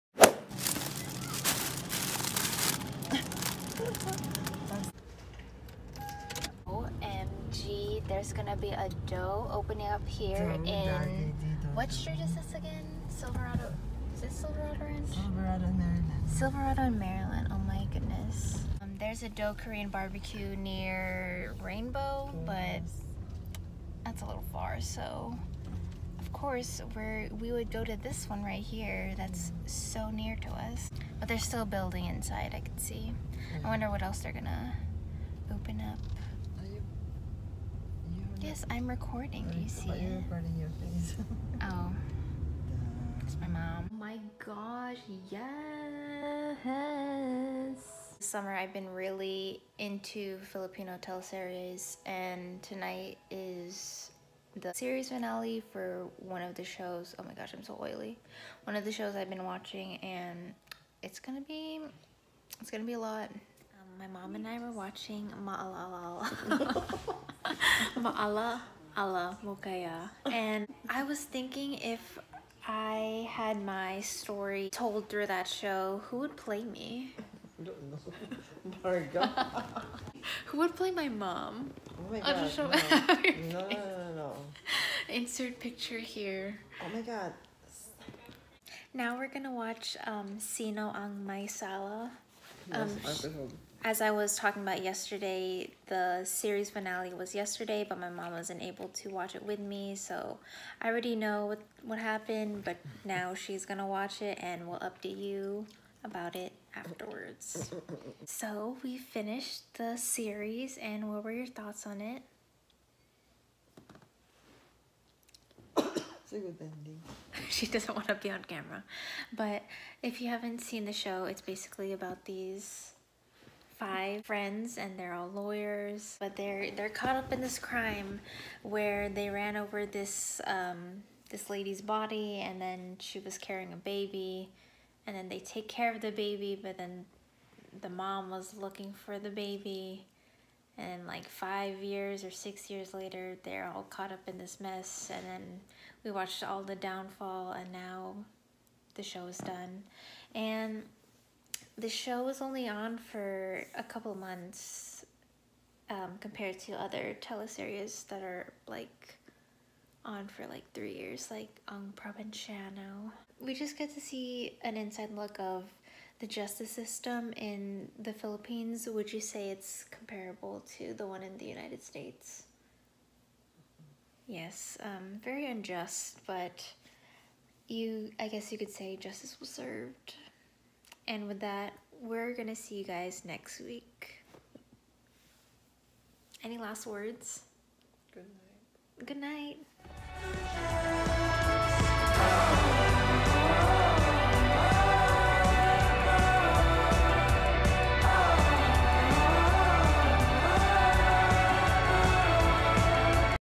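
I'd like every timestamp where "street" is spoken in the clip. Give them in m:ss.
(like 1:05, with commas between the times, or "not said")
0:11.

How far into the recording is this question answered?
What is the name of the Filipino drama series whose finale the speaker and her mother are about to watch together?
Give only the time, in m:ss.
1:30.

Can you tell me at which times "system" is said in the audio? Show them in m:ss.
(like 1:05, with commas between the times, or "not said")
2:46.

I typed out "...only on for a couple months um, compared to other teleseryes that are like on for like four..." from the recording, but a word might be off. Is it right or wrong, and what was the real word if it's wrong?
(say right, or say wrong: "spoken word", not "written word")
wrong: "three", not "four".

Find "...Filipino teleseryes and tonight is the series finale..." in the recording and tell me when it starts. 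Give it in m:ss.
0:50.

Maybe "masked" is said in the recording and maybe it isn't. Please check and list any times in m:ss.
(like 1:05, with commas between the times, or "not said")
not said.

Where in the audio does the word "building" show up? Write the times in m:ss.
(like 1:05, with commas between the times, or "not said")
0:31.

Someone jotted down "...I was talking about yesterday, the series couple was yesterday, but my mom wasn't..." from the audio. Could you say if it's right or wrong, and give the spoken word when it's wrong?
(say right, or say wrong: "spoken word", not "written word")
wrong: "finale", not "couple".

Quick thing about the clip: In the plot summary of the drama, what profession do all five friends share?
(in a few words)
Lawyers.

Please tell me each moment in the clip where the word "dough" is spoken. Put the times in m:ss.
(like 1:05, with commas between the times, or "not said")
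0:09, 0:19.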